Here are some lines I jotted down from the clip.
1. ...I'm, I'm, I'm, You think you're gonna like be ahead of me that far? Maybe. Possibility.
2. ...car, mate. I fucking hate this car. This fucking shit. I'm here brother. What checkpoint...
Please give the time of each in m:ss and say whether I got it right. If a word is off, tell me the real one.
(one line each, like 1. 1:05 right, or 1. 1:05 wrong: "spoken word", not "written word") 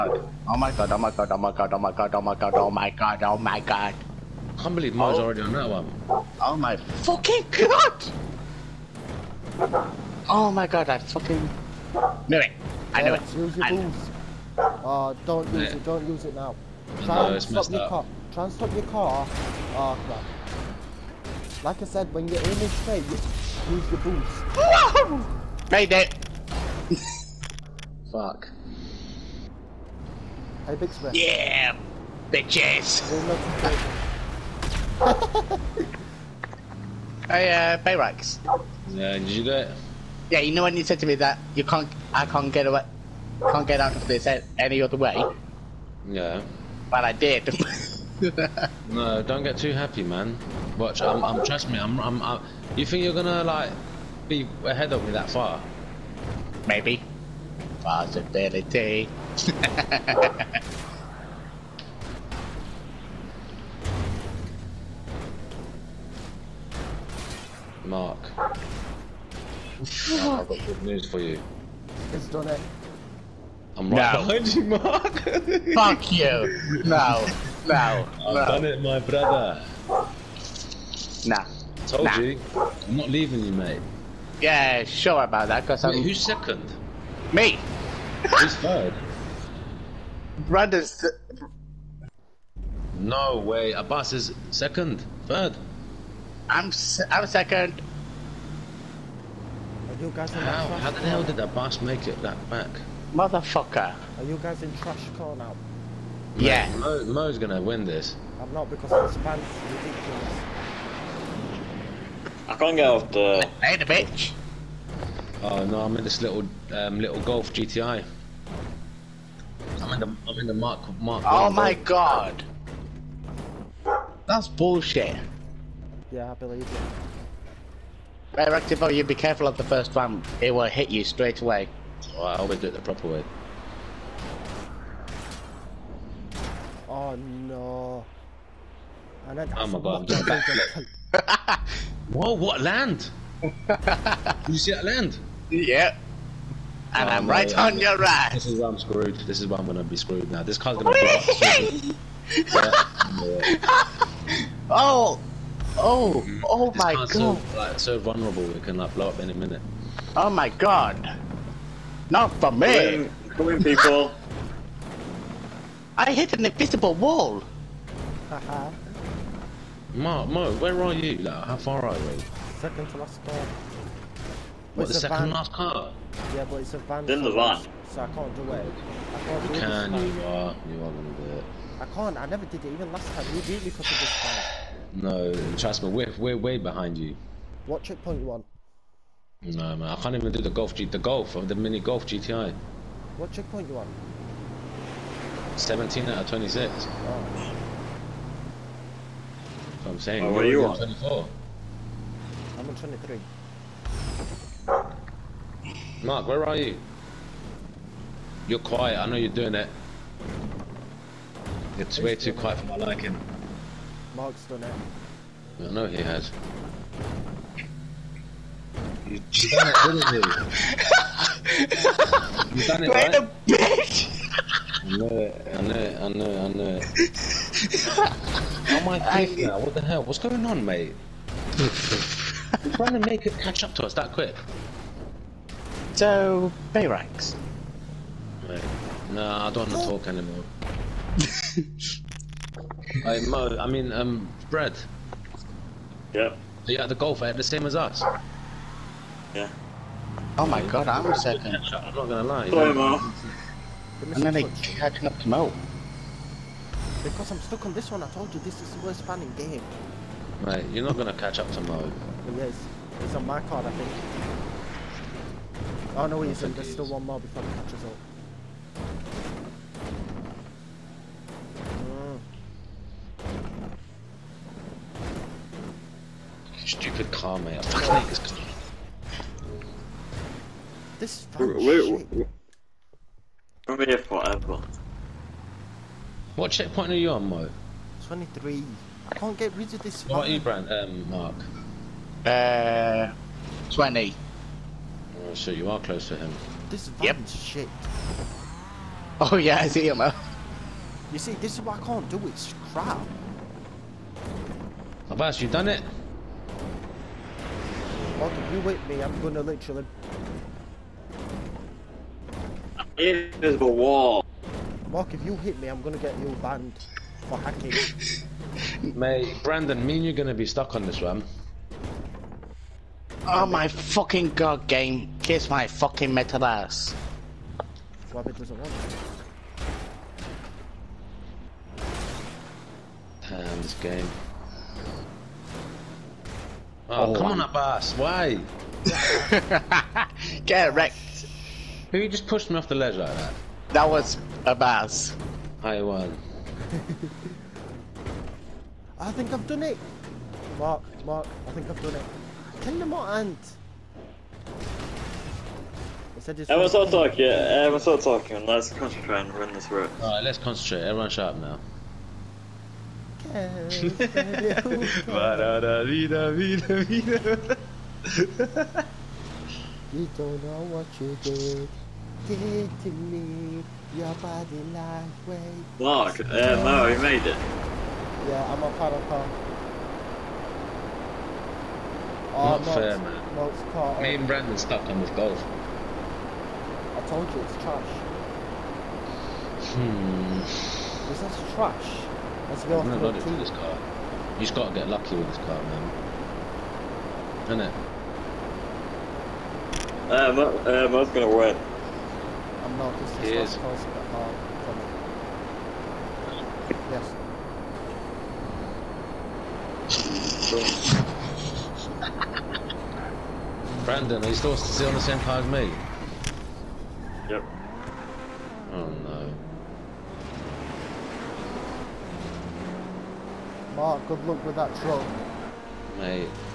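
1. 0:51 right
2. 4:37 wrong: "forever", not "brother".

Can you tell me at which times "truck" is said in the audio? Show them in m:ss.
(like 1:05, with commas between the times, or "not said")
7:04.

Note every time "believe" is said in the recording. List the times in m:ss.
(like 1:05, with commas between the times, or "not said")
0:04, 2:06.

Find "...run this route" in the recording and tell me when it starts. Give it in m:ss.
5:59.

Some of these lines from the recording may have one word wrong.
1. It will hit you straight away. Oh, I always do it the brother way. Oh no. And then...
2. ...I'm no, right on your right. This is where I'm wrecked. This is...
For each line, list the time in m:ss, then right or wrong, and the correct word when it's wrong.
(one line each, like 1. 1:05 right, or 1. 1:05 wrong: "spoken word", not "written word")
1. 2:10 wrong: "proper", not "brother"
2. 2:27 wrong: "screwed", not "wrecked".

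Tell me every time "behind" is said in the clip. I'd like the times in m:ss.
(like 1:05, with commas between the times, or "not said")
1:14, 3:06.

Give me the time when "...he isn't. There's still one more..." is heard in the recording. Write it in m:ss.
4:26.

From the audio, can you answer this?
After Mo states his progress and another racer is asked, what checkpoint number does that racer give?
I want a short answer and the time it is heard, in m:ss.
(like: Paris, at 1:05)
20, at 4:53.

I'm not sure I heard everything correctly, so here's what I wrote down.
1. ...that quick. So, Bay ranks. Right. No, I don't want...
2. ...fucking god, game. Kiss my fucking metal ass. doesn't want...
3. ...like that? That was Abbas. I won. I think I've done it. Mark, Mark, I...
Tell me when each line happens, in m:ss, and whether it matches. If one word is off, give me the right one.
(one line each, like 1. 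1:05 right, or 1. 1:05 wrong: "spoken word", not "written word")
1. 3:53 right
2. 5:23 right
3. 5:42 right.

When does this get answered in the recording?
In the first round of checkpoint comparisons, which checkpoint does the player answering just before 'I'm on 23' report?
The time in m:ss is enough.
3:20.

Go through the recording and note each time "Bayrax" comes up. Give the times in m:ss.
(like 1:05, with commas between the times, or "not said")
0:37.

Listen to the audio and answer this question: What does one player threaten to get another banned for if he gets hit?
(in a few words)
Hacking.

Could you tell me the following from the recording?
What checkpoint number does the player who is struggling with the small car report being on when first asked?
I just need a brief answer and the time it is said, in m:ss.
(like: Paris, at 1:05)
17, at 3:15.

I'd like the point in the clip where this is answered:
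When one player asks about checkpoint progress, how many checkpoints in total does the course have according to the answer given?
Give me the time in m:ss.
3:15.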